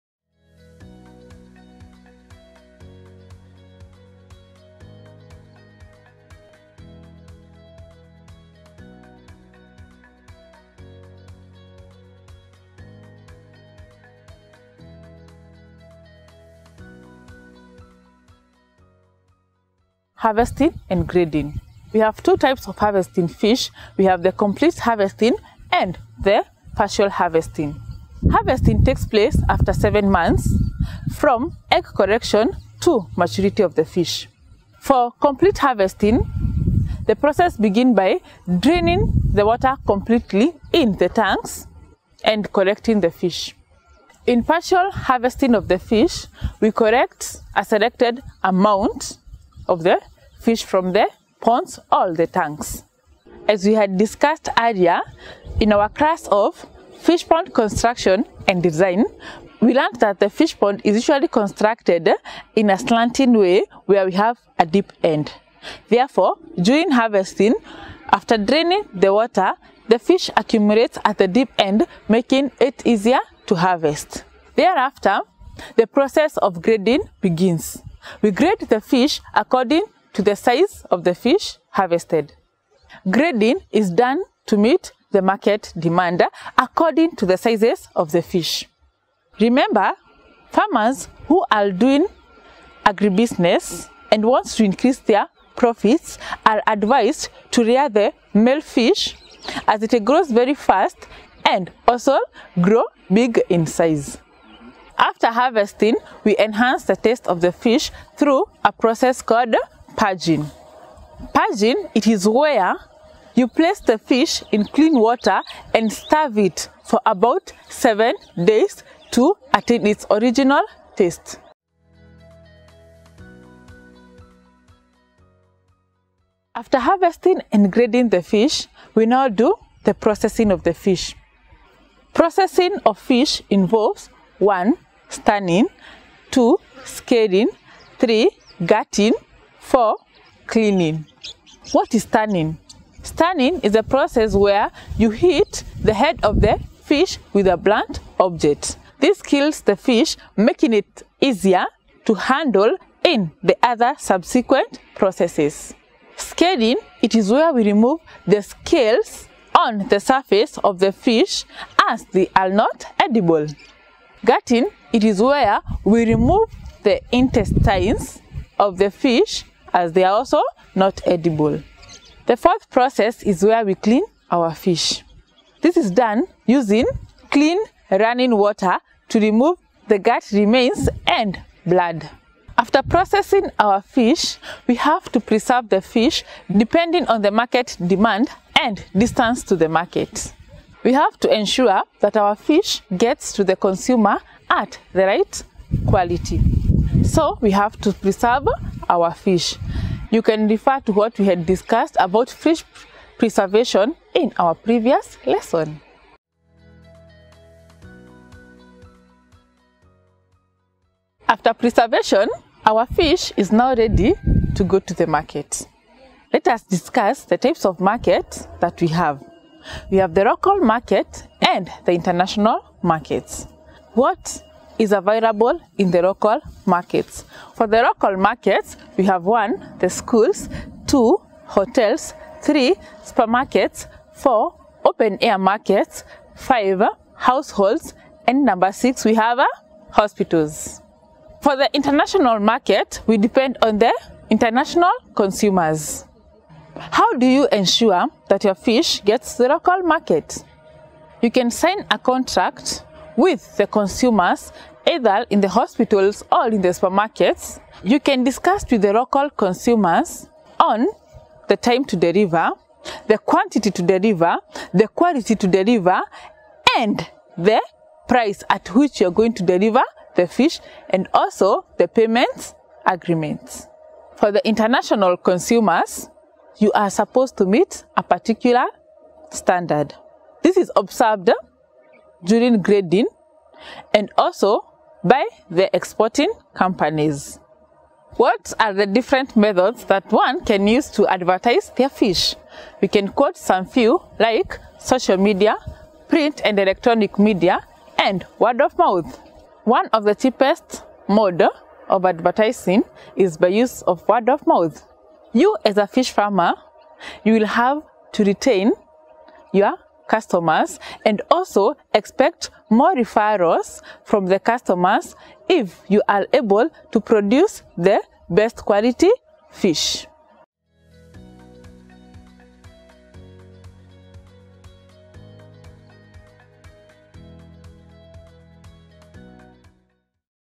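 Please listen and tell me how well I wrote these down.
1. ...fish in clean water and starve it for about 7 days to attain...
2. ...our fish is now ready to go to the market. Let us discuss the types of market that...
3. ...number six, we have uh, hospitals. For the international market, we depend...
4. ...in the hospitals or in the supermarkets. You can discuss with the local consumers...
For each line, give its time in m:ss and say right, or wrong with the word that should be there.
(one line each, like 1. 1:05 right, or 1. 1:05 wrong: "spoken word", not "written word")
1. 1:53 right
2. 3:32 right
3. 3:58 right
4. 4:15 right.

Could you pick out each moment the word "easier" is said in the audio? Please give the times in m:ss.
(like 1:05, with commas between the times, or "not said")
1:12, 2:31.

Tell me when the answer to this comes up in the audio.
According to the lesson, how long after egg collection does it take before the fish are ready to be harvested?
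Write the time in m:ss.
0:29.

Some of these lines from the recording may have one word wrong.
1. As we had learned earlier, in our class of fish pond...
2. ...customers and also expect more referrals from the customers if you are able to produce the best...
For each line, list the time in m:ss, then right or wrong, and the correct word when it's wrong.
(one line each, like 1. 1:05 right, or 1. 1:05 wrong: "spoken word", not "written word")
1. 0:53 wrong: "discussed", not "learned"
2. 5:10 right.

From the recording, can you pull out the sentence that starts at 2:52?
The fourth process is where we clean our fish.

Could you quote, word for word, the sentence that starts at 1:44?
After harvesting, we enhance the taste of the fish through a process called purging.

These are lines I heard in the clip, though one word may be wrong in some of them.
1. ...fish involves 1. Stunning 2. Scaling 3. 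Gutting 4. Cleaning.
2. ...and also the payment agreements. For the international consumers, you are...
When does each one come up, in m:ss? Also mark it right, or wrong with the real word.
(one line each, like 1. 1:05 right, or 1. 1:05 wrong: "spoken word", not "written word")
1. 2:12 right
2. 4:30 right.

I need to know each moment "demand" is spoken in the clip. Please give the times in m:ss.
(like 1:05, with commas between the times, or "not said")
1:25, 3:07.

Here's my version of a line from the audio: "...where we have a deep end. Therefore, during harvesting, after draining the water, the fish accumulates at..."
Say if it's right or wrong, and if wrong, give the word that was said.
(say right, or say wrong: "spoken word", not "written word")
right.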